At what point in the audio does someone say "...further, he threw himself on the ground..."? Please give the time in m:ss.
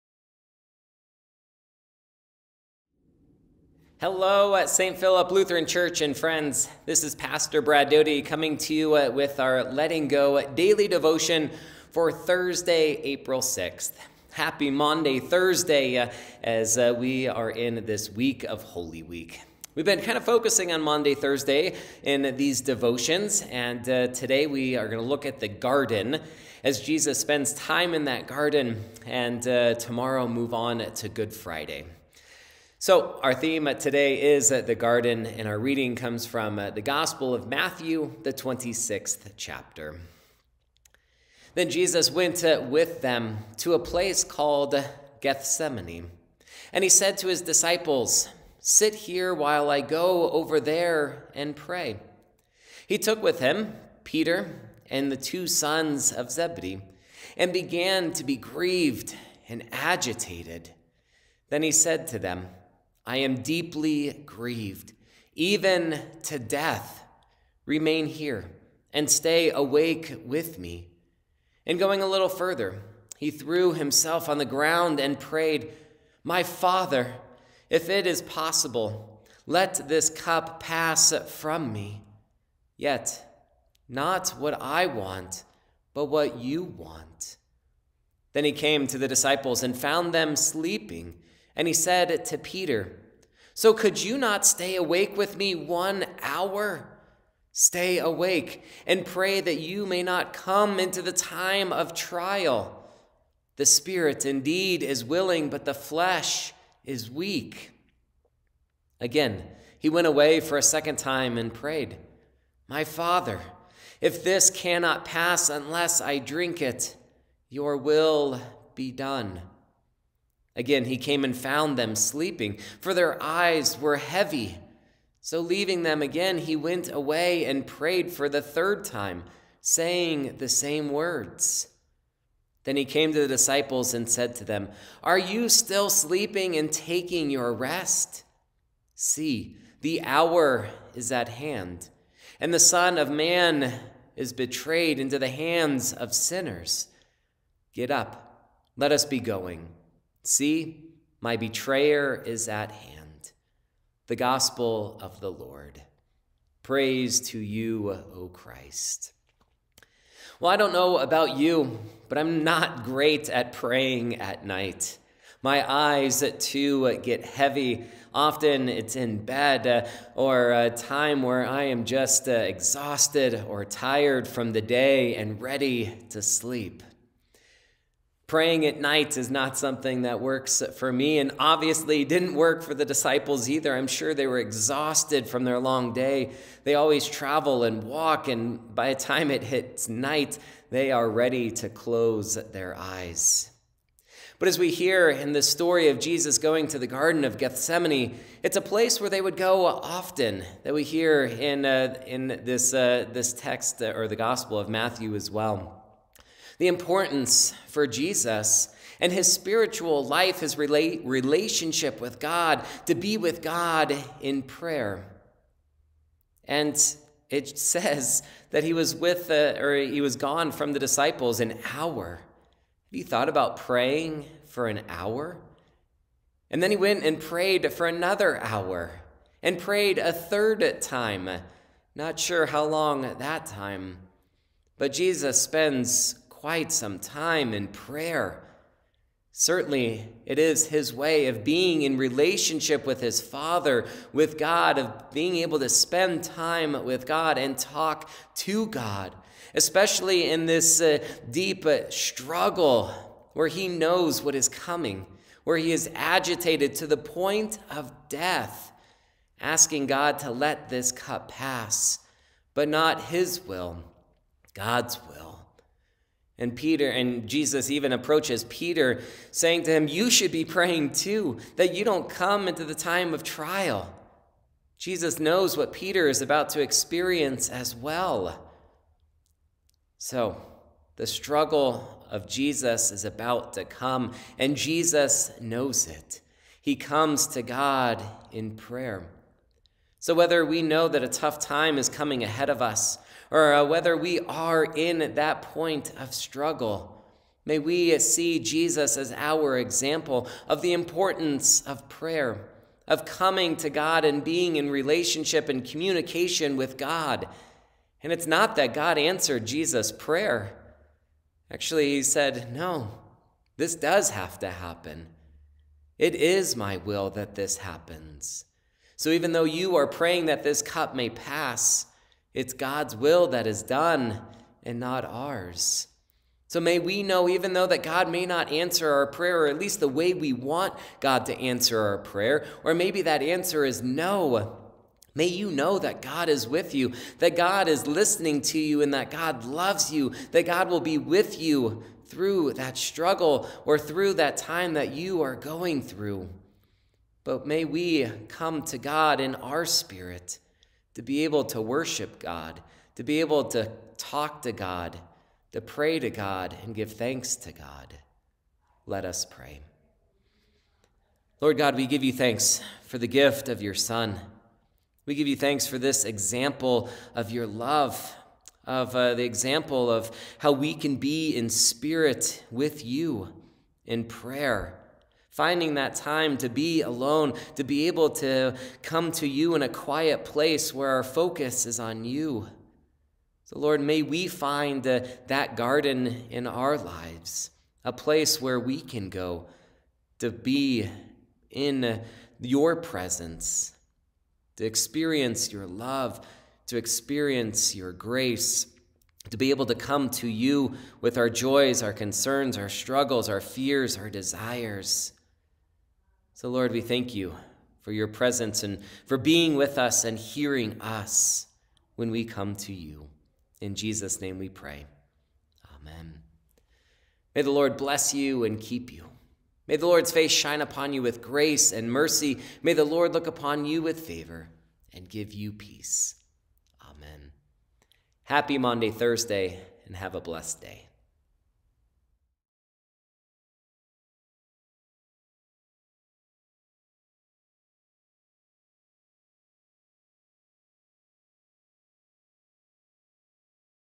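1:12.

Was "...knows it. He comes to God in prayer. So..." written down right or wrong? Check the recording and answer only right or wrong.
right.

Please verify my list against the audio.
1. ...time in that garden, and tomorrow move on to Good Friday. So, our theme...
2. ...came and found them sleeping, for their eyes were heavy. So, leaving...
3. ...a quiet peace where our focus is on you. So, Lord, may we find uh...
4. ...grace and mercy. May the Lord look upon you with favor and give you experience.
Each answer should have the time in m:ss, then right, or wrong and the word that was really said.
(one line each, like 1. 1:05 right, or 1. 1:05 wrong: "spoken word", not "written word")
1. 0:27 right
2. 2:00 right
3. 6:19 wrong: "place", not "peace"
4. 7:01 wrong: "peace", not "experience".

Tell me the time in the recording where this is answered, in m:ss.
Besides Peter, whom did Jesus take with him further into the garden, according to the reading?
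0:55.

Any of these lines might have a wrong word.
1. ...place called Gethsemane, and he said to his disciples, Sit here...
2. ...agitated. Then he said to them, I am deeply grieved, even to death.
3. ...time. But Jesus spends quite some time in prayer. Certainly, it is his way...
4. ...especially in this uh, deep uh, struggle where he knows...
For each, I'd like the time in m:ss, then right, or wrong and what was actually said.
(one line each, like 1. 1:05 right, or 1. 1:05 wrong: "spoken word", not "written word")
1. 0:43 right
2. 0:59 right
3. 3:53 right
4. 4:09 right.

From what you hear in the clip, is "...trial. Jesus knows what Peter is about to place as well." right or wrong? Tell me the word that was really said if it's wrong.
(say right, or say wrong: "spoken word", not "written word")
wrong: "experience", not "place".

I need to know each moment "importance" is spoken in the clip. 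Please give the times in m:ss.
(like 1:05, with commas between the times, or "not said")
3:26, 5:00.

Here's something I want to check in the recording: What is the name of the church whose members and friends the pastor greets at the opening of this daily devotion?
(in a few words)
St. Philip Lutheran Church.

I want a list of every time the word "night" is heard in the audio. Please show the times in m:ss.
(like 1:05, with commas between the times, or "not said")
2:44, 2:58, 3:09.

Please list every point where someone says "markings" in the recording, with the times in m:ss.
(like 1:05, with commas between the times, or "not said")
not said.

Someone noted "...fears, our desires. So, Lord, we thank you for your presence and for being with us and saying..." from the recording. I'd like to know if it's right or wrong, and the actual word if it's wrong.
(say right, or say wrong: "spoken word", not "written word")
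wrong: "hearing", not "saying".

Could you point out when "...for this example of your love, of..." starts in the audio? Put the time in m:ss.
6:05.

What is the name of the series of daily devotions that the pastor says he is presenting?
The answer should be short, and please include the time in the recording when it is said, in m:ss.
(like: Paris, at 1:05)
Letting Go, at 0:09.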